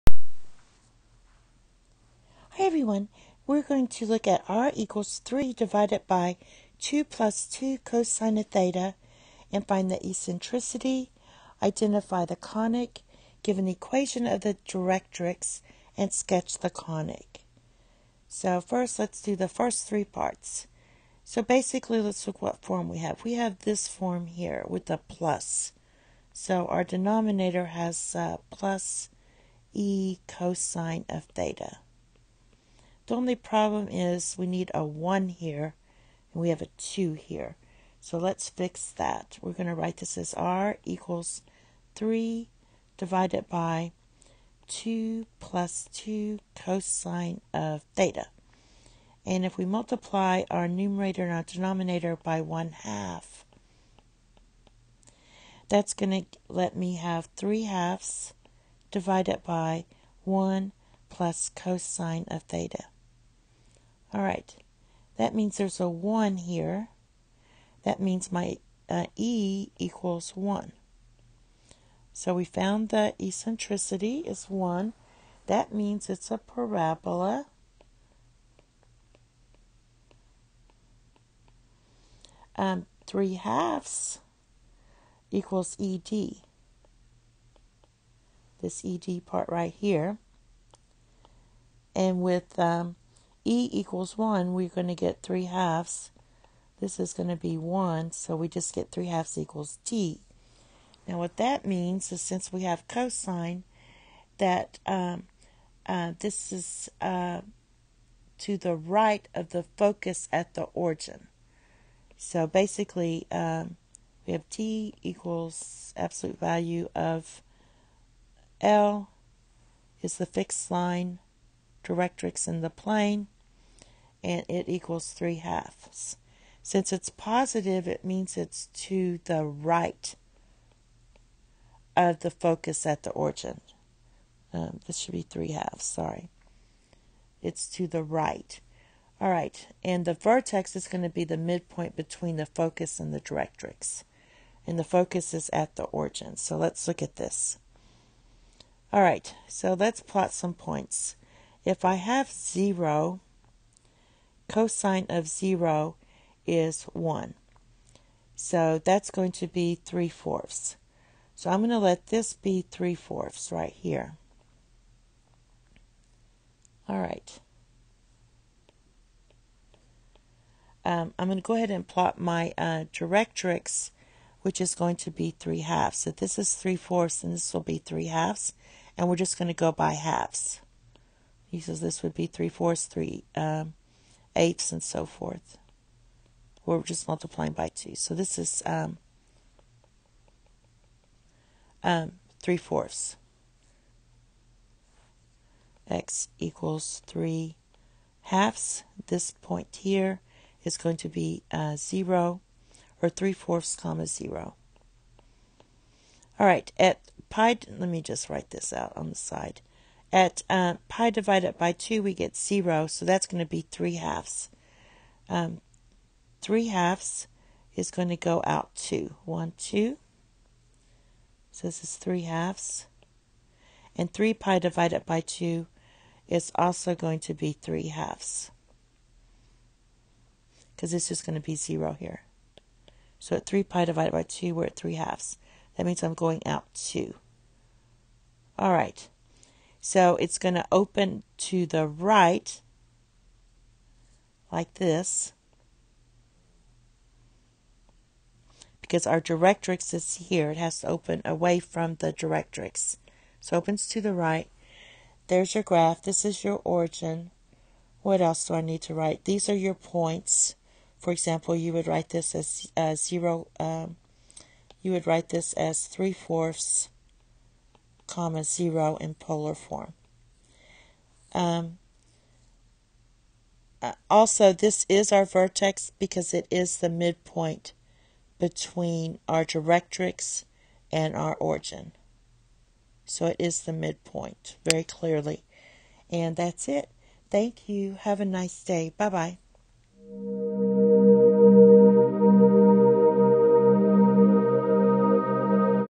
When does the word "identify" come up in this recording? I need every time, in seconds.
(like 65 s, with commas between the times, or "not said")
11 s.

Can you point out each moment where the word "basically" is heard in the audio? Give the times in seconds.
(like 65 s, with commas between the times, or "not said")
21 s, 112 s.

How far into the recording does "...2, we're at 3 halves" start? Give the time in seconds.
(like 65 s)
234 s.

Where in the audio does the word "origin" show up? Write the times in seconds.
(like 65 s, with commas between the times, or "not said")
110 s, 133 s, 145 s, 256 s, 281 s.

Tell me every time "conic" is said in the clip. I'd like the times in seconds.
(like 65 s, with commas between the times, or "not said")
12 s, 16 s.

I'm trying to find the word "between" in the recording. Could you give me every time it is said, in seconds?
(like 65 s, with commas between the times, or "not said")
141 s, 278 s.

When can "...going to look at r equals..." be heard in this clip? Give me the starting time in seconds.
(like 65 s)
3 s.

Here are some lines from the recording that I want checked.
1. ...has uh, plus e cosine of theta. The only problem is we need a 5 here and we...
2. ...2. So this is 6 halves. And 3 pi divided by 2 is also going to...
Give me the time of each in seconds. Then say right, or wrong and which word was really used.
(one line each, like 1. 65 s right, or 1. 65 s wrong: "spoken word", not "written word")
1. 27 s wrong: "1", not "5"
2. 219 s wrong: "3", not "6".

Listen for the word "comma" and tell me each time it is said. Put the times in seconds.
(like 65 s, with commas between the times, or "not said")
203 s, 268 s.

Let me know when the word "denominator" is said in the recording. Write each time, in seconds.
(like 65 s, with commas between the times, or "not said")
26 s, 51 s.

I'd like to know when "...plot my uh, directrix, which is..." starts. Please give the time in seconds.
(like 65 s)
171 s.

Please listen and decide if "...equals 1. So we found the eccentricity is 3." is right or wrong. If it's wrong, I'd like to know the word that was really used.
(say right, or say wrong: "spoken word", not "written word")
wrong: "1", not "3".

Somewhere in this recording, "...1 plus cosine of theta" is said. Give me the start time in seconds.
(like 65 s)
60 s.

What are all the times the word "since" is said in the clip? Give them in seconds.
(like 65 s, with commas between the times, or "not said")
102 s, 126 s.